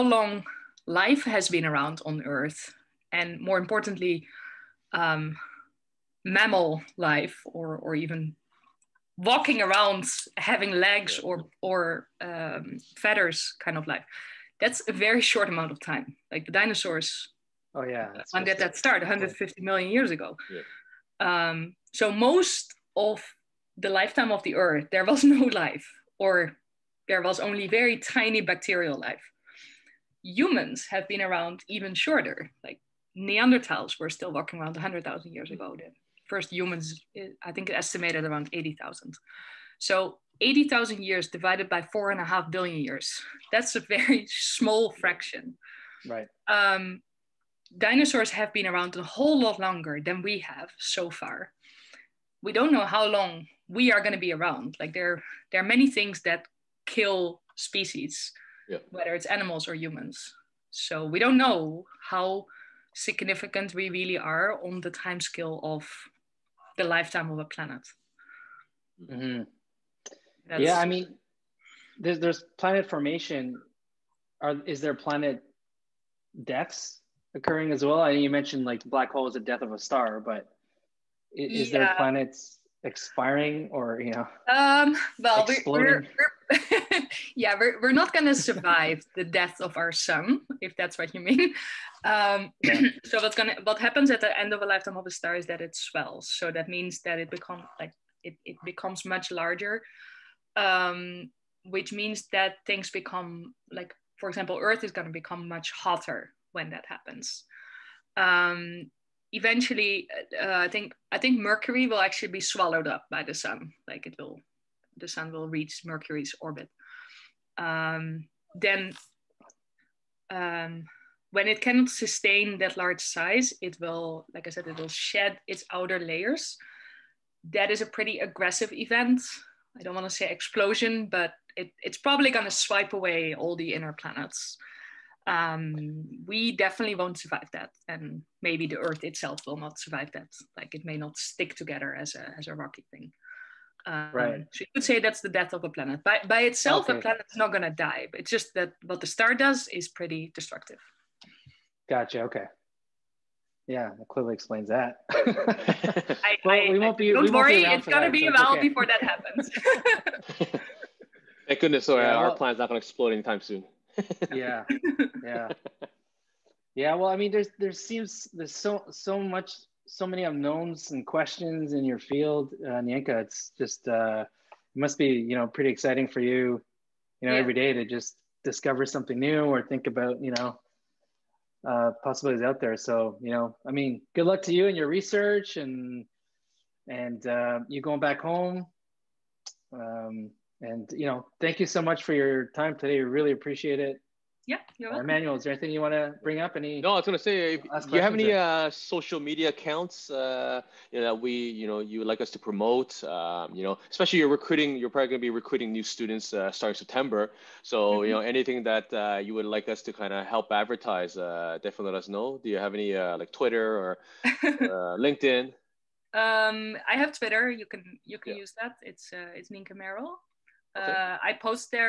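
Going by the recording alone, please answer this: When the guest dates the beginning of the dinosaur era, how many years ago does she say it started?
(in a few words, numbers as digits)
150 million years ago.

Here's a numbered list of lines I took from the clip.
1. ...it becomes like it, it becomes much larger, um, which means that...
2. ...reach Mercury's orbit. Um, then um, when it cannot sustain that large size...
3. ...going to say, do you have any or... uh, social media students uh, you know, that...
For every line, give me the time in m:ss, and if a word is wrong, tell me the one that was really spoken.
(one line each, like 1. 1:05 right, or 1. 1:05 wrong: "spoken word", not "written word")
1. 1:37 right
2. 1:55 right
3. 3:17 wrong: "accounts", not "students".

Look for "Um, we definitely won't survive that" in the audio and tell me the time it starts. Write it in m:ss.
2:15.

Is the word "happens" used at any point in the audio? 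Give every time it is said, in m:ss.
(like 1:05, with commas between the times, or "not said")
1:33, 1:46, 2:39.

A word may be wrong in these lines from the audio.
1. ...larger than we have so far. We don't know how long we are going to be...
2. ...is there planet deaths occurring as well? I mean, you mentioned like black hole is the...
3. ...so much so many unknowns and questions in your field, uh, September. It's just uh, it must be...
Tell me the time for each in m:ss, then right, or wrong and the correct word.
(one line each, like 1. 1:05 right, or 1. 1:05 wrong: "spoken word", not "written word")
1. 0:49 wrong: "longer", not "larger"
2. 1:14 right
3. 2:48 wrong: "Nienke", not "September".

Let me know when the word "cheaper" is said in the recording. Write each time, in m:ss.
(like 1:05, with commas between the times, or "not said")
not said.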